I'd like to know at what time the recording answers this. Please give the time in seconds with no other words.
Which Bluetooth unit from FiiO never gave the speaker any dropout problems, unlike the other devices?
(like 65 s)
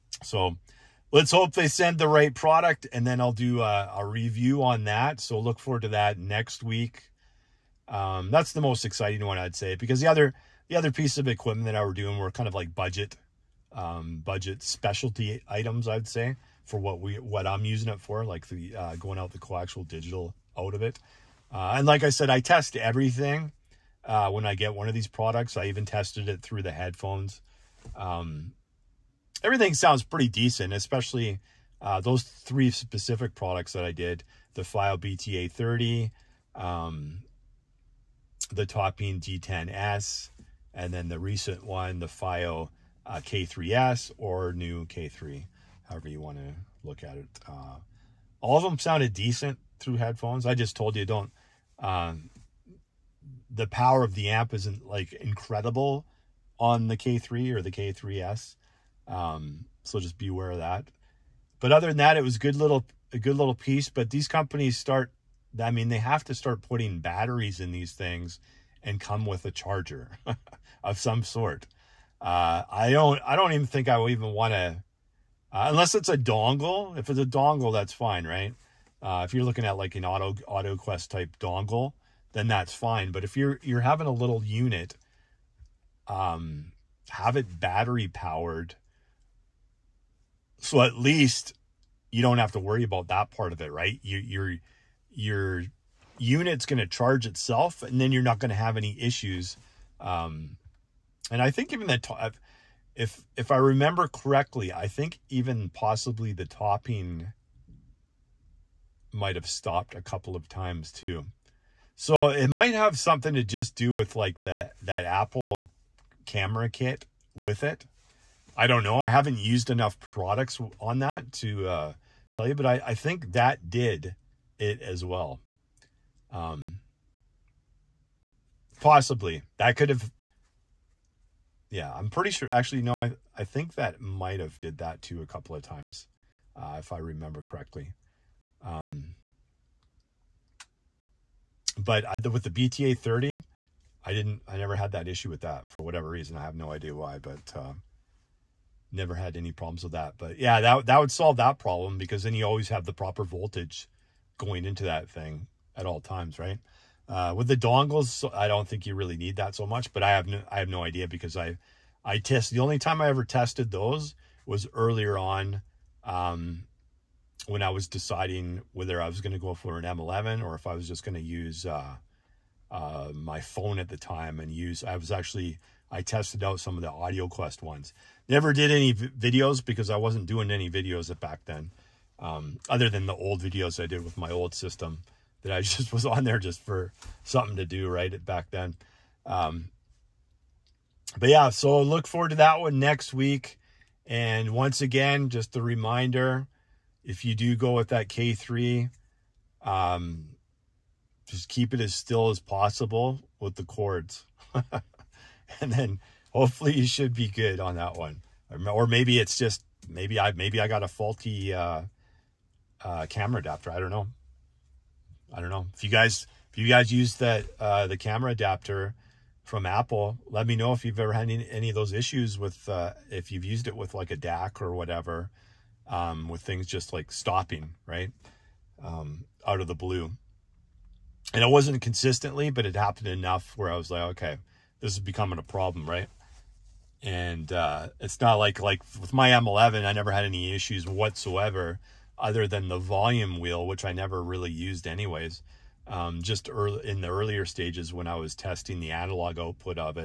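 142 s.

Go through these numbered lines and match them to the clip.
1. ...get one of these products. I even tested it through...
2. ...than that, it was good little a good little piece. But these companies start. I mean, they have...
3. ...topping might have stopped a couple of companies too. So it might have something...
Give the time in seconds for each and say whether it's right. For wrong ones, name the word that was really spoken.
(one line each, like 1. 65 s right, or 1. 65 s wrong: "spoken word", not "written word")
1. 24 s right
2. 61 s right
3. 106 s wrong: "times", not "companies".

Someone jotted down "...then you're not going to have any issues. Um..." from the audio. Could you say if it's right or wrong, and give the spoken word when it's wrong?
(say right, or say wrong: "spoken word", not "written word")
right.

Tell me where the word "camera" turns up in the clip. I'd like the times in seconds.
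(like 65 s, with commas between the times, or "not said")
116 s, 213 s, 217 s.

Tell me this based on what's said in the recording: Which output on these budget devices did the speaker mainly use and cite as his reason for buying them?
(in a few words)
Coaxial digital out.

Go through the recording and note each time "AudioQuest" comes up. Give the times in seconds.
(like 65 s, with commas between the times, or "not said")
80 s, 176 s.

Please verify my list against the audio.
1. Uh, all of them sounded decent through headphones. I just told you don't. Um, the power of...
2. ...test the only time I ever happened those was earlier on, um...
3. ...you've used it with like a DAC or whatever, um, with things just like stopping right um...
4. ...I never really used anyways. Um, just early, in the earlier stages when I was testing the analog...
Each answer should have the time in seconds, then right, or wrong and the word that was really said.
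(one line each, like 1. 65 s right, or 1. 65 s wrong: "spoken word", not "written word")
1. 47 s right
2. 162 s wrong: "tested", not "happened"
3. 223 s right
4. 243 s right.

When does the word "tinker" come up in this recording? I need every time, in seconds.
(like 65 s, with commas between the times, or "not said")
not said.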